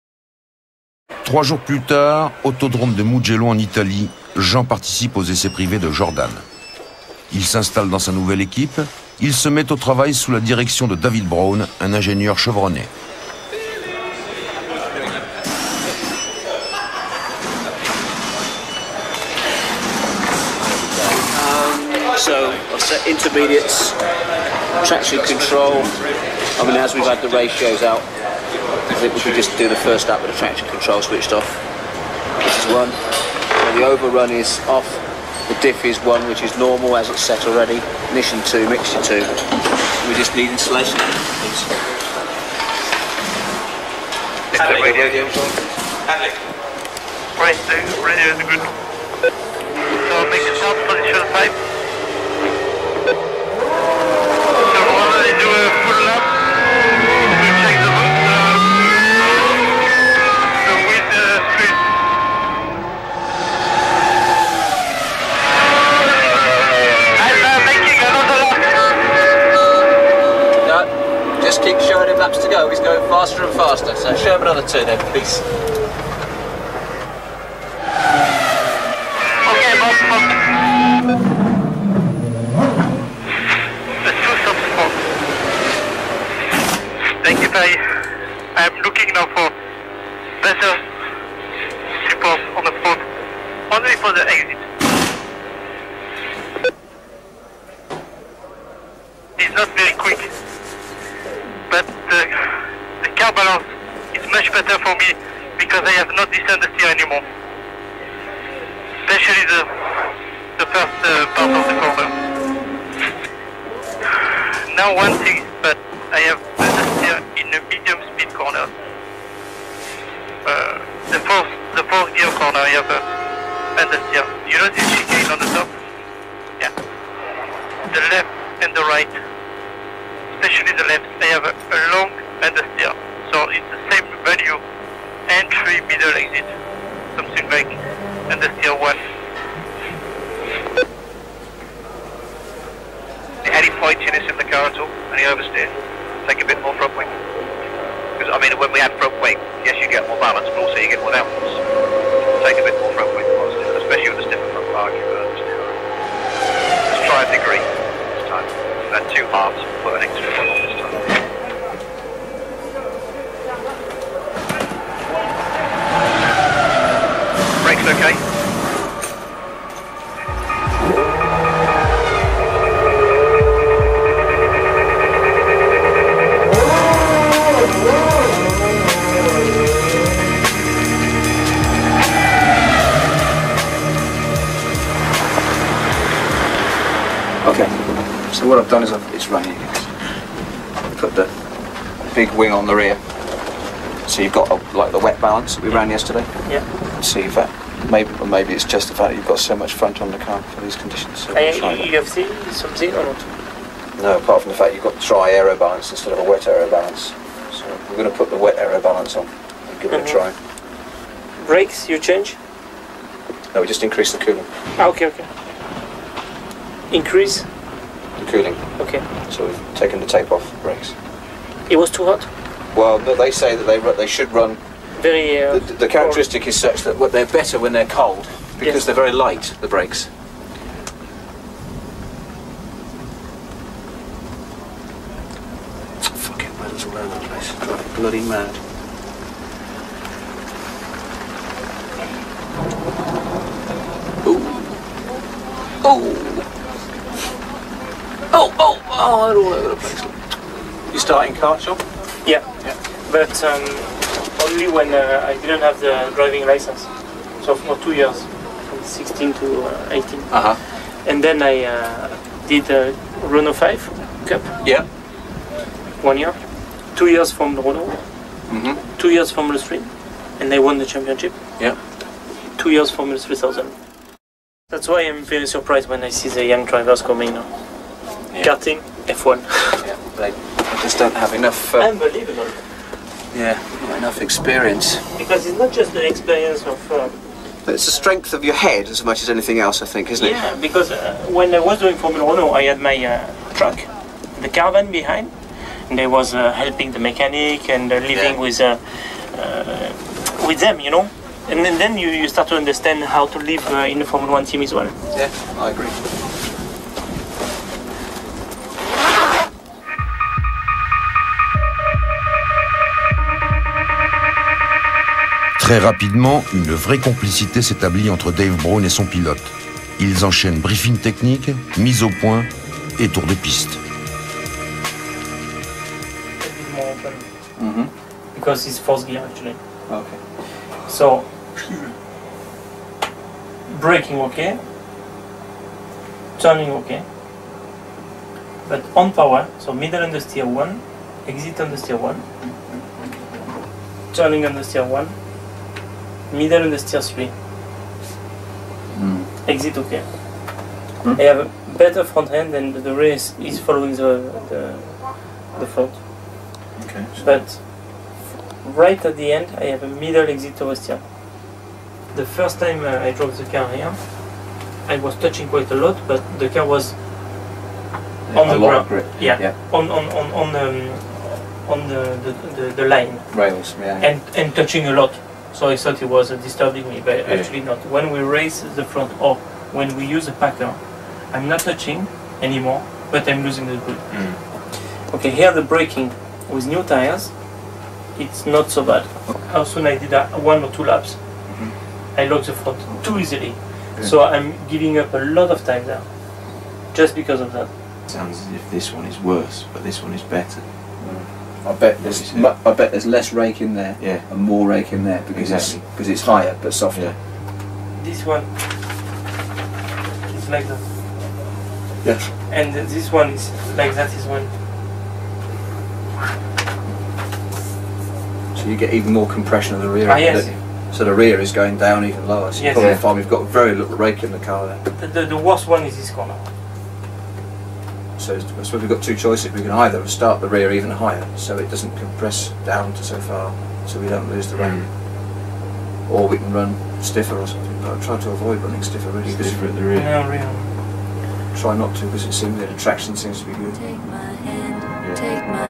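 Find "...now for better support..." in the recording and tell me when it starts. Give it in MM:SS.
01:29.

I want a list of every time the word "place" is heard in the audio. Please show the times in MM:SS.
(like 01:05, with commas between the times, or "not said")
03:57, 04:09.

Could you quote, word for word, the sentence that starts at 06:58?
So you get even more compression of the rear.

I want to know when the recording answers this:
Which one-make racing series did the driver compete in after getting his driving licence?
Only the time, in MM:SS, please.
04:23.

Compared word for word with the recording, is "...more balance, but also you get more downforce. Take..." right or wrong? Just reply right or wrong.
right.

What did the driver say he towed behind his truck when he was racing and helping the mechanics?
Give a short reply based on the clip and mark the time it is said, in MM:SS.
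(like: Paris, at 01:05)
caravan, at 04:54.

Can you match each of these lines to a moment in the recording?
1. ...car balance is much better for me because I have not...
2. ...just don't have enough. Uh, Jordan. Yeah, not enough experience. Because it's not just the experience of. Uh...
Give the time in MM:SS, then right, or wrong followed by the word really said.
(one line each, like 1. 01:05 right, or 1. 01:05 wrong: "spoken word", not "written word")
1. 01:43 right
2. 04:40 wrong: "Unbelievable", not "Jordan".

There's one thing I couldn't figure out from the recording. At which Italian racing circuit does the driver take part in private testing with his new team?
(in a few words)
Mugello.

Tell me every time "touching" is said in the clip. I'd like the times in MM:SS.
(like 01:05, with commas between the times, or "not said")
06:05, 06:14, 06:21.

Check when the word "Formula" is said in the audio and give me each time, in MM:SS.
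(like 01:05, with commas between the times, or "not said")
04:51, 05:04.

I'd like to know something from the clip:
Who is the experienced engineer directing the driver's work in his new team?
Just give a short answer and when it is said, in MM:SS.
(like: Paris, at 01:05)
David Brown, at 00:10.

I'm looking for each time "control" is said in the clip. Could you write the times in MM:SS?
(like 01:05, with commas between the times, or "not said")
00:25, 00:30.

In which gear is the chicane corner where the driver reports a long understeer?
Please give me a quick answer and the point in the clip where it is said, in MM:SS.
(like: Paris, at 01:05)
fourth gear, at 02:01.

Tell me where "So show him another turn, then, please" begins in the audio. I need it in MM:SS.
01:13.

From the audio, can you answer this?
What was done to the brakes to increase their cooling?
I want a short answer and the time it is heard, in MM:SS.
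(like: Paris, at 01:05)
taken the tape off, at 03:39.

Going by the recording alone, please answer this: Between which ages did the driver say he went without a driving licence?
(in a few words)
16 to 18.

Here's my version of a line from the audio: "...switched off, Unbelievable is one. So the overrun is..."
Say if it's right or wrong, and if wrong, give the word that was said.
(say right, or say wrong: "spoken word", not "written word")
wrong: "This", not "Unbelievable".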